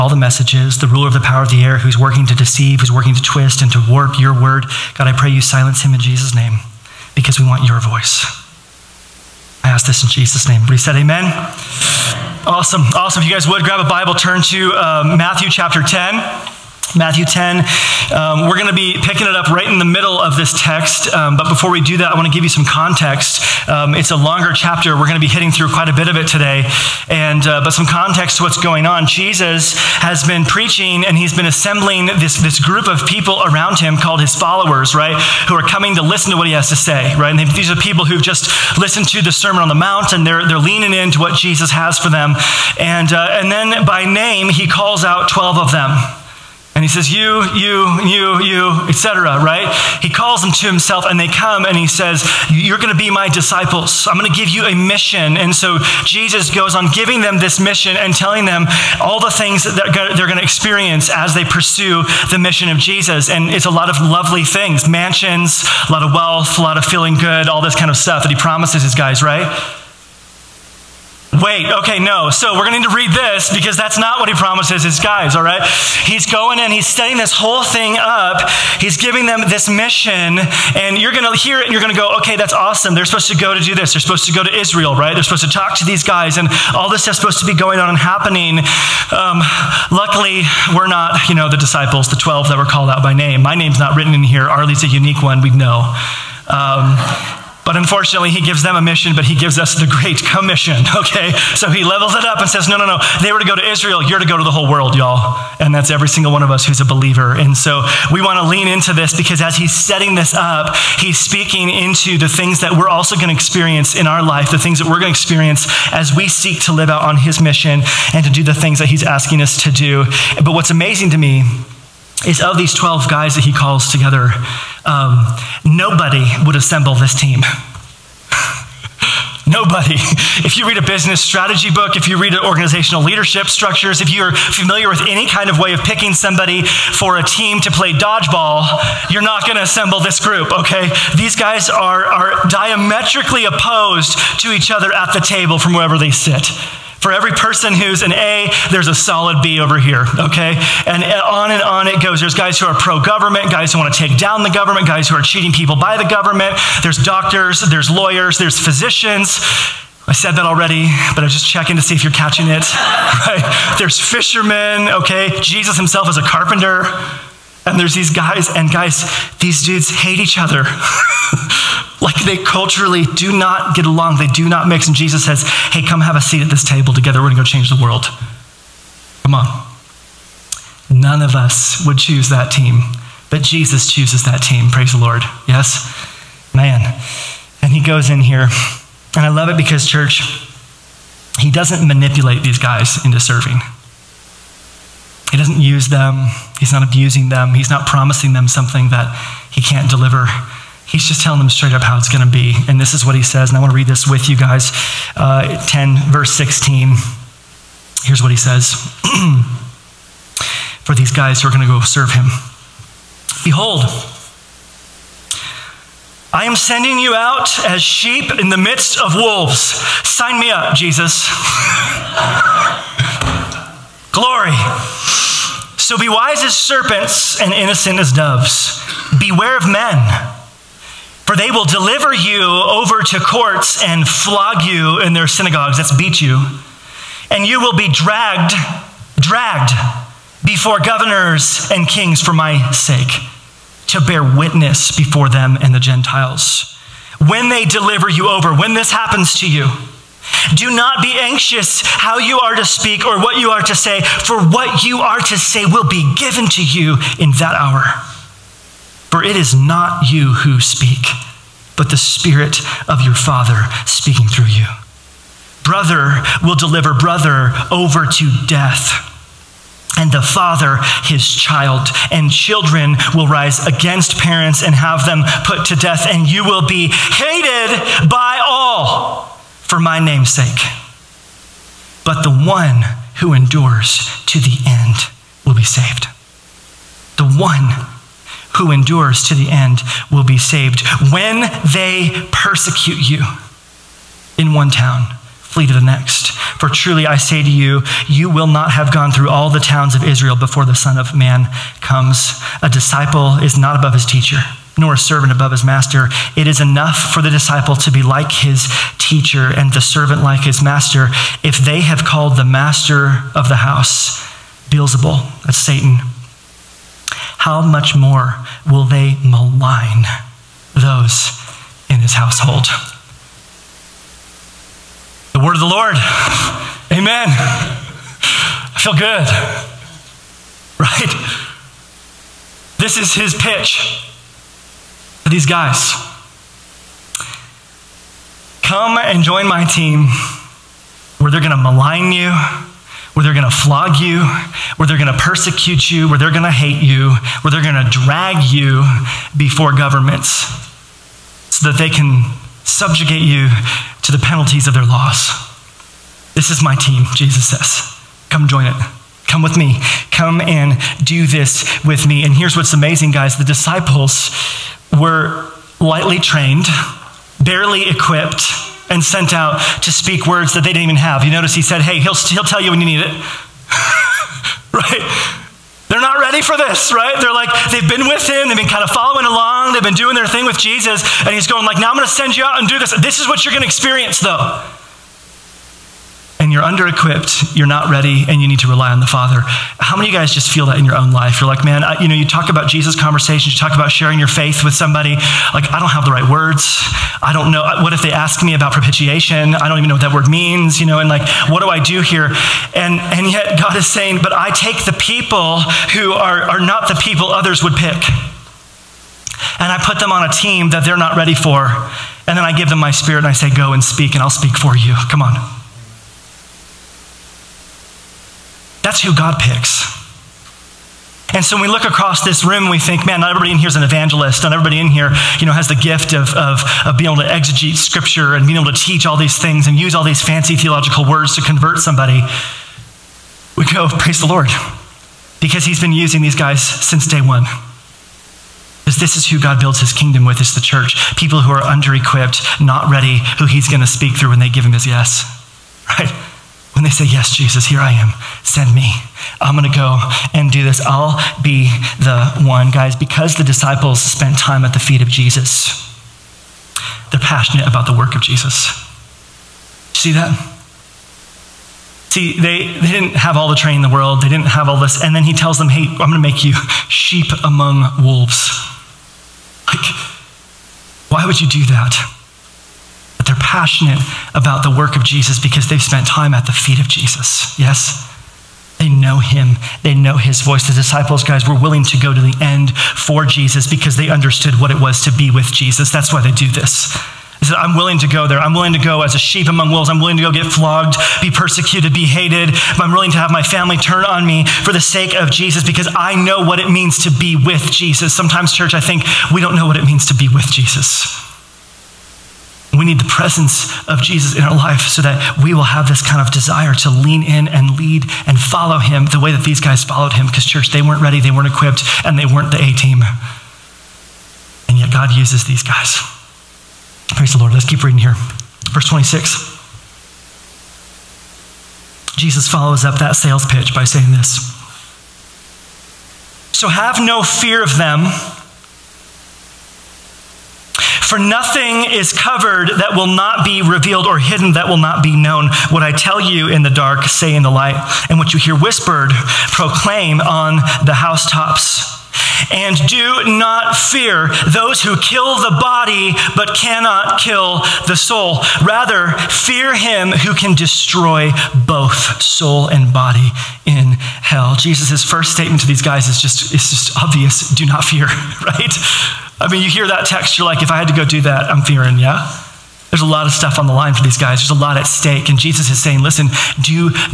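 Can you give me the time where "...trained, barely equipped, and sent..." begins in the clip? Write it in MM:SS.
06:06.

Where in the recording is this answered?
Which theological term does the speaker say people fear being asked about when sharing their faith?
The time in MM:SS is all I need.
06:38.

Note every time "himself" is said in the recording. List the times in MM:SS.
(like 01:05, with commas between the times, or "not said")
00:50, 02:45.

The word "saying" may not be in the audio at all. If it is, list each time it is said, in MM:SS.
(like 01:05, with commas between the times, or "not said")
06:43, 08:43, 09:25.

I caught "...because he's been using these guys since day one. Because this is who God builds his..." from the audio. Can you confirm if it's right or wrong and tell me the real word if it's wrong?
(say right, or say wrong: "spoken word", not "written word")
right.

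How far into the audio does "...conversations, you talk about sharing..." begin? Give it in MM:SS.
06:32.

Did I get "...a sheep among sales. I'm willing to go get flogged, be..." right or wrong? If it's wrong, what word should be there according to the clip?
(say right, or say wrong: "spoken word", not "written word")
wrong: "wolves", not "sales".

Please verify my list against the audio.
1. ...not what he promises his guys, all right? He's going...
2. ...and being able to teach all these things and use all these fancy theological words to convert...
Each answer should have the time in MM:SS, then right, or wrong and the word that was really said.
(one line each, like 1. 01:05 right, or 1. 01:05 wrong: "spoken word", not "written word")
1. 01:13 right
2. 07:08 right.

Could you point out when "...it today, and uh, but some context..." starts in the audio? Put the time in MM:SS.
00:26.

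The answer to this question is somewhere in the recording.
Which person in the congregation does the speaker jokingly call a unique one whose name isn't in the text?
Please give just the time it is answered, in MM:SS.
01:34.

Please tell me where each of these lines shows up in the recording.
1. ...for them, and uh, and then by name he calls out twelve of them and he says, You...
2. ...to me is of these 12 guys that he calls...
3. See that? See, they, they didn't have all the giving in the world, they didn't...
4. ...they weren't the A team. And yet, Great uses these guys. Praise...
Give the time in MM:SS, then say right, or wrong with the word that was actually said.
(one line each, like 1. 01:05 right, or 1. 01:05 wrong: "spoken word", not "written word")
1. 00:41 right
2. 02:01 right
3. 07:39 wrong: "training", not "giving"
4. 08:32 wrong: "God", not "Great".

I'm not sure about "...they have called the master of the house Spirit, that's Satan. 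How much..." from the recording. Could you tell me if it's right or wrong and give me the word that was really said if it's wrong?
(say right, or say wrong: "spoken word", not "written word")
wrong: "Beelzebul", not "Spirit".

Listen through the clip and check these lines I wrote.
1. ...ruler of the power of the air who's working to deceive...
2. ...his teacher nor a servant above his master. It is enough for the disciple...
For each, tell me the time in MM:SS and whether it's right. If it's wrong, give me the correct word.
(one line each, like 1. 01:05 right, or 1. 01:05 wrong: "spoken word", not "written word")
1. 00:00 right
2. 05:03 right.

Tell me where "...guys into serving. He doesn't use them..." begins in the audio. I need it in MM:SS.
03:12.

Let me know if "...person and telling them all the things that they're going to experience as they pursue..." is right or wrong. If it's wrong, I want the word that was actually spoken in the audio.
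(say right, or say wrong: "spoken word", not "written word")
wrong: "mission", not "person".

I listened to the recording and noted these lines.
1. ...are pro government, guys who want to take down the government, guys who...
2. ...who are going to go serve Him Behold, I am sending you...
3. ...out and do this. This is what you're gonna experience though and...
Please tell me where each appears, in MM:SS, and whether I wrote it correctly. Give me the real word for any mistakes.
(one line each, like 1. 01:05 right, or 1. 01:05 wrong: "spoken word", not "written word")
1. 02:32 right
2. 03:31 right
3. 06:22 right.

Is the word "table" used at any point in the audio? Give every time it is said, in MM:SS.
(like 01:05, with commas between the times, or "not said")
02:25, 02:56.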